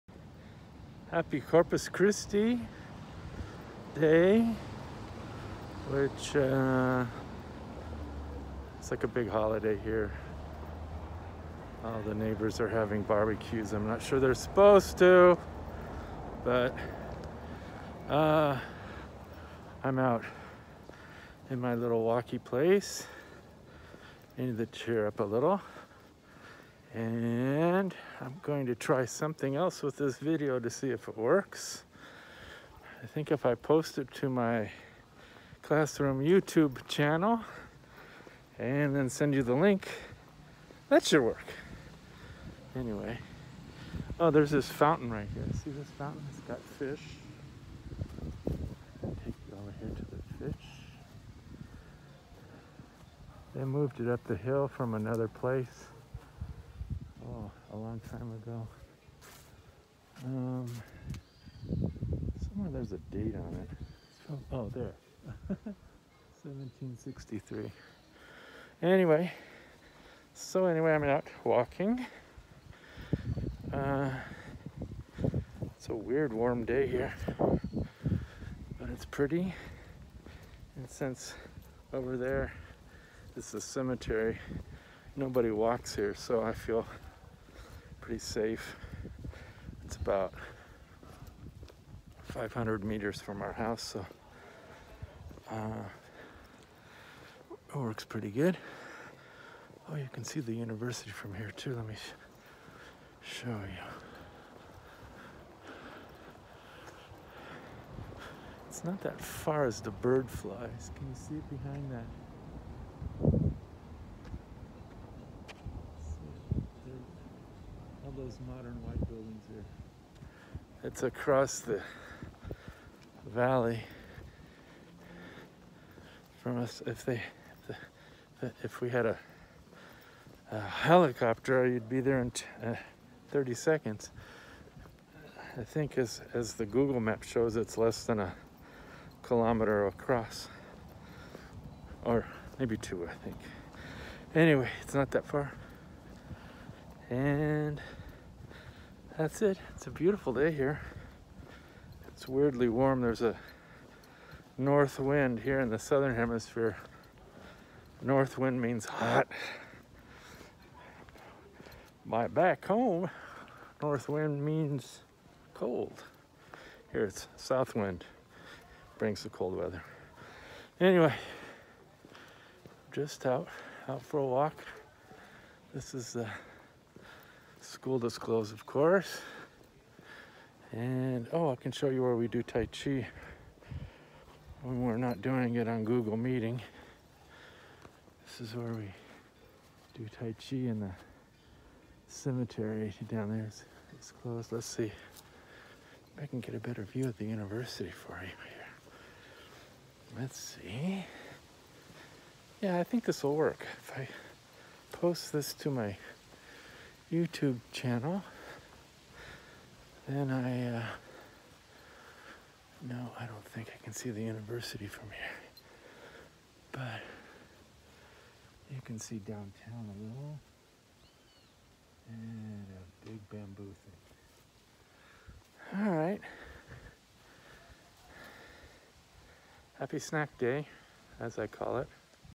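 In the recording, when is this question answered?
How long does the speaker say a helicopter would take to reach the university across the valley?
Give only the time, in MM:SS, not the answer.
02:13.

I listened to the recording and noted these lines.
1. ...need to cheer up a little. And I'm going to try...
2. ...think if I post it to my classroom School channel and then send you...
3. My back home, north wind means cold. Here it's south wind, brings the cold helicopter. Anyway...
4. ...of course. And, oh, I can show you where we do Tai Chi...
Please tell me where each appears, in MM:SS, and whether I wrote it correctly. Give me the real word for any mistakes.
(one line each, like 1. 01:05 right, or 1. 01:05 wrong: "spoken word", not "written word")
1. 00:24 right
2. 00:33 wrong: "YouTube", not "School"
3. 02:42 wrong: "weather", not "helicopter"
4. 02:58 right.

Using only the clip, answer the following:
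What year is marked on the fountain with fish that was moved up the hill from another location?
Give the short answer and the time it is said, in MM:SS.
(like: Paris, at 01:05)
1763, at 01:06.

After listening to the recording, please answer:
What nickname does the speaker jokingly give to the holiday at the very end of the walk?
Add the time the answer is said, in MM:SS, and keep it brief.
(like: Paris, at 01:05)
Happy snack day, at 03:49.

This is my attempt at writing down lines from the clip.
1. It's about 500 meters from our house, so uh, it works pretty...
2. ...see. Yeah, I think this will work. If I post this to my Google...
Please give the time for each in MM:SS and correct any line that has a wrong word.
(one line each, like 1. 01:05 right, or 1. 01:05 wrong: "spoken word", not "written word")
1. 01:29 right
2. 03:20 wrong: "YouTube", not "Google".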